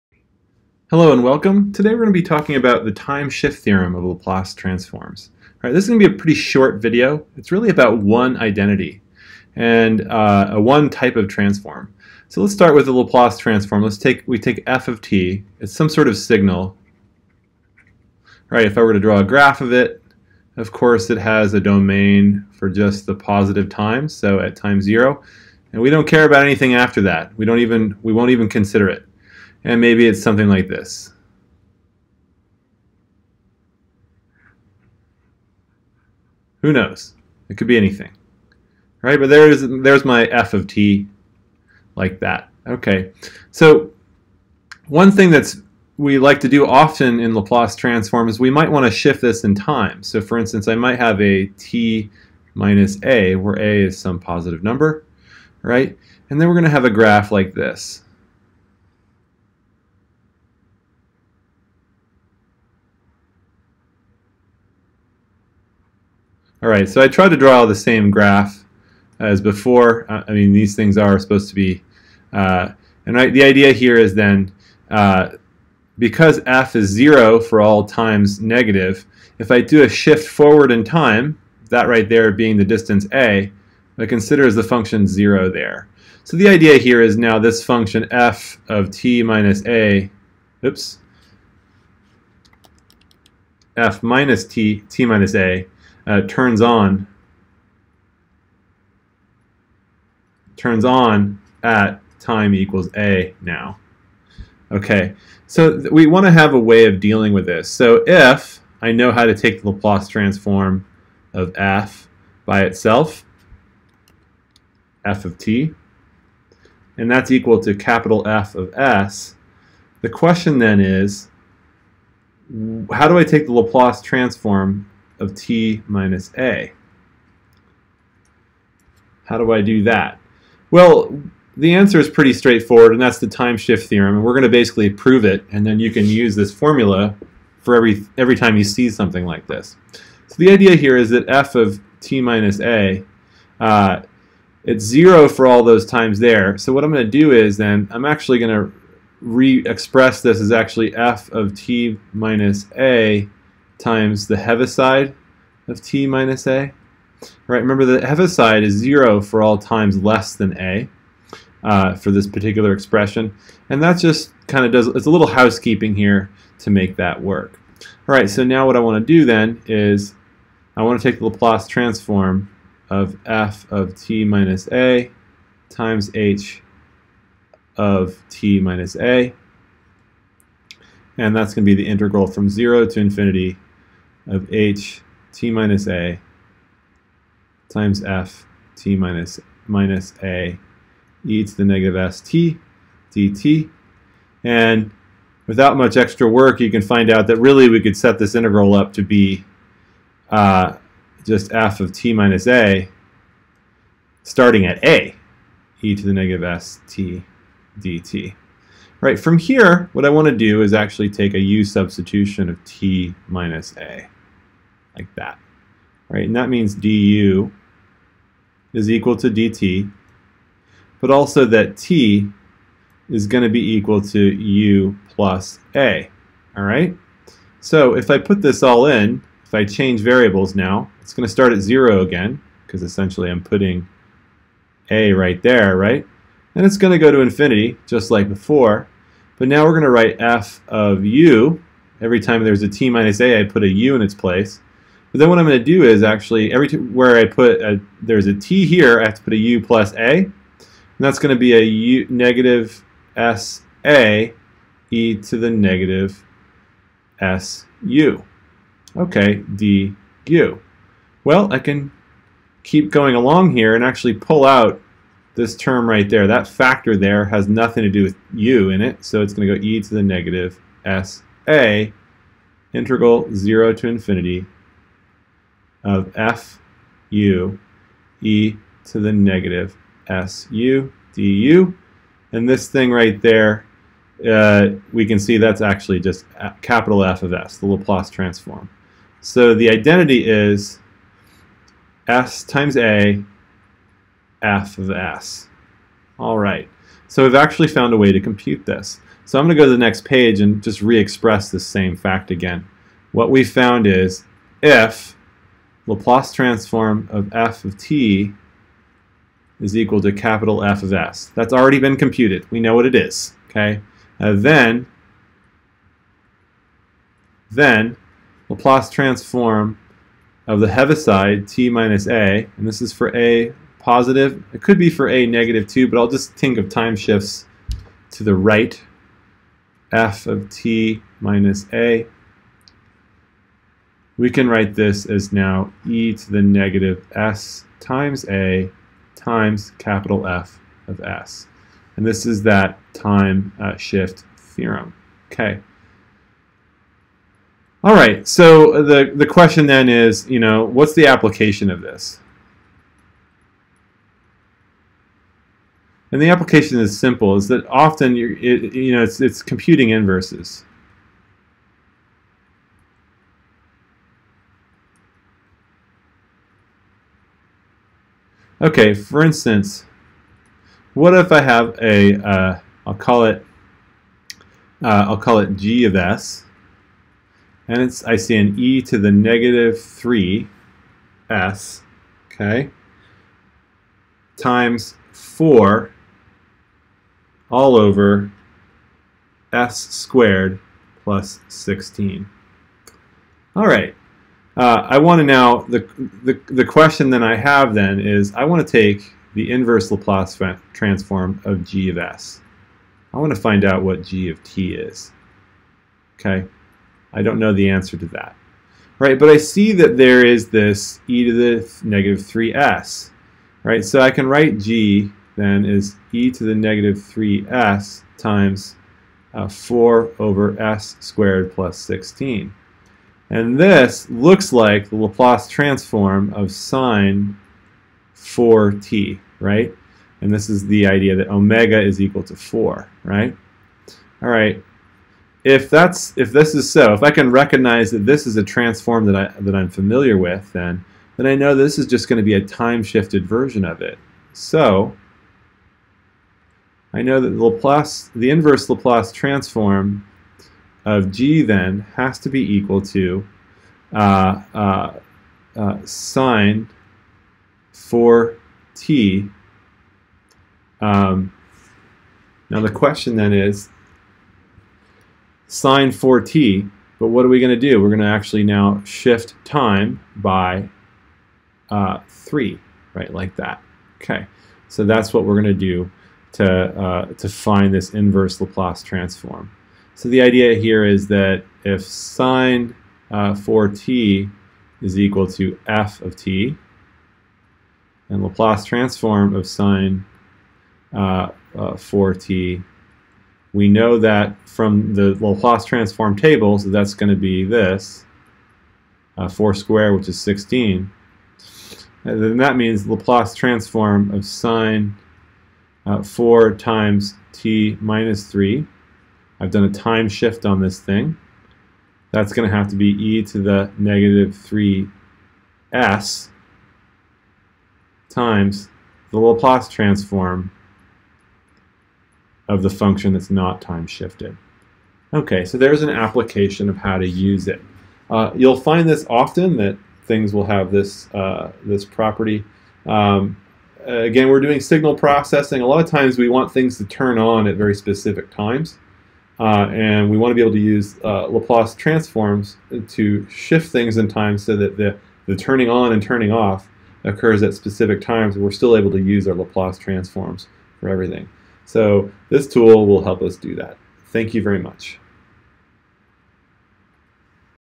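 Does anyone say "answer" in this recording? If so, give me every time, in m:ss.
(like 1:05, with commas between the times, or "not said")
2:11, 6:47.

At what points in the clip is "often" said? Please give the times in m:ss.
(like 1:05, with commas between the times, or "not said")
0:46, 5:57, 8:49.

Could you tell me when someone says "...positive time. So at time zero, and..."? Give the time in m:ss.
0:23.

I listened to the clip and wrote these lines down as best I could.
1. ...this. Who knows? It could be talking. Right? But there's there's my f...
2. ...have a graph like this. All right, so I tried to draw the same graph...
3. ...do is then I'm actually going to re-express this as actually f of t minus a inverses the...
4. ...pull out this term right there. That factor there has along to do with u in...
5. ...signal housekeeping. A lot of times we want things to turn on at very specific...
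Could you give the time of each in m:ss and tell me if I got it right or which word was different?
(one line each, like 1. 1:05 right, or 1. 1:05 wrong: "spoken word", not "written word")
1. 0:30 wrong: "anything", not "talking"
2. 0:56 right
3. 2:27 wrong: "times", not "inverses"
4. 4:24 wrong: "nothing", not "along"
5. 8:54 wrong: "processing", not "housekeeping".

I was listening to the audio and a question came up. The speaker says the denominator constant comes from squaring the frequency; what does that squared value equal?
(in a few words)
16.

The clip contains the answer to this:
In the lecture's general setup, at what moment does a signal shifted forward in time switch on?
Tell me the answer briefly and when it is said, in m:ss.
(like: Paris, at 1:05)
time equals a, at 1:42.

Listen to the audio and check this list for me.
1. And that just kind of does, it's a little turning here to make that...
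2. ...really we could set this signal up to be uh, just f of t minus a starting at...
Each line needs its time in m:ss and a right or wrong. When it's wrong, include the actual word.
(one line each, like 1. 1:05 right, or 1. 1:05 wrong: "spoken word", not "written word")
1. 2:43 wrong: "housekeeping", not "turning"
2. 3:17 wrong: "integral", not "signal".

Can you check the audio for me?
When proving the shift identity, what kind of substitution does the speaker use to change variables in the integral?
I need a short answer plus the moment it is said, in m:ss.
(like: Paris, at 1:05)
u substitution, at 3:31.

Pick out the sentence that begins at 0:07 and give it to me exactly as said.
It's really about one identity and uh, a one type of transform.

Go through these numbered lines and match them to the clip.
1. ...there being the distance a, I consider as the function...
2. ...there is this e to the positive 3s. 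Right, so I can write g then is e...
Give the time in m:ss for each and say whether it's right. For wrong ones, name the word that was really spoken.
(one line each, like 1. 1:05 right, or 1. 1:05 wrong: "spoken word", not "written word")
1. 1:22 right
2. 6:49 wrong: "negative", not "positive".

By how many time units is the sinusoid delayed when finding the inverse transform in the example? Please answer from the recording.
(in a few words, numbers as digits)
3.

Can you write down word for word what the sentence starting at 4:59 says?
So I'm going to go to the next page and just re-express this same fact again.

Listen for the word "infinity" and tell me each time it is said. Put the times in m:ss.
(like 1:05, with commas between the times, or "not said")
3:02, 3:57, 4:33.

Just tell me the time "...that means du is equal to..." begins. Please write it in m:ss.
3:36.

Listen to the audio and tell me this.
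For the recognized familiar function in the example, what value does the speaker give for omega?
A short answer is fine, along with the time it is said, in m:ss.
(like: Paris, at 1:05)
4, at 7:11.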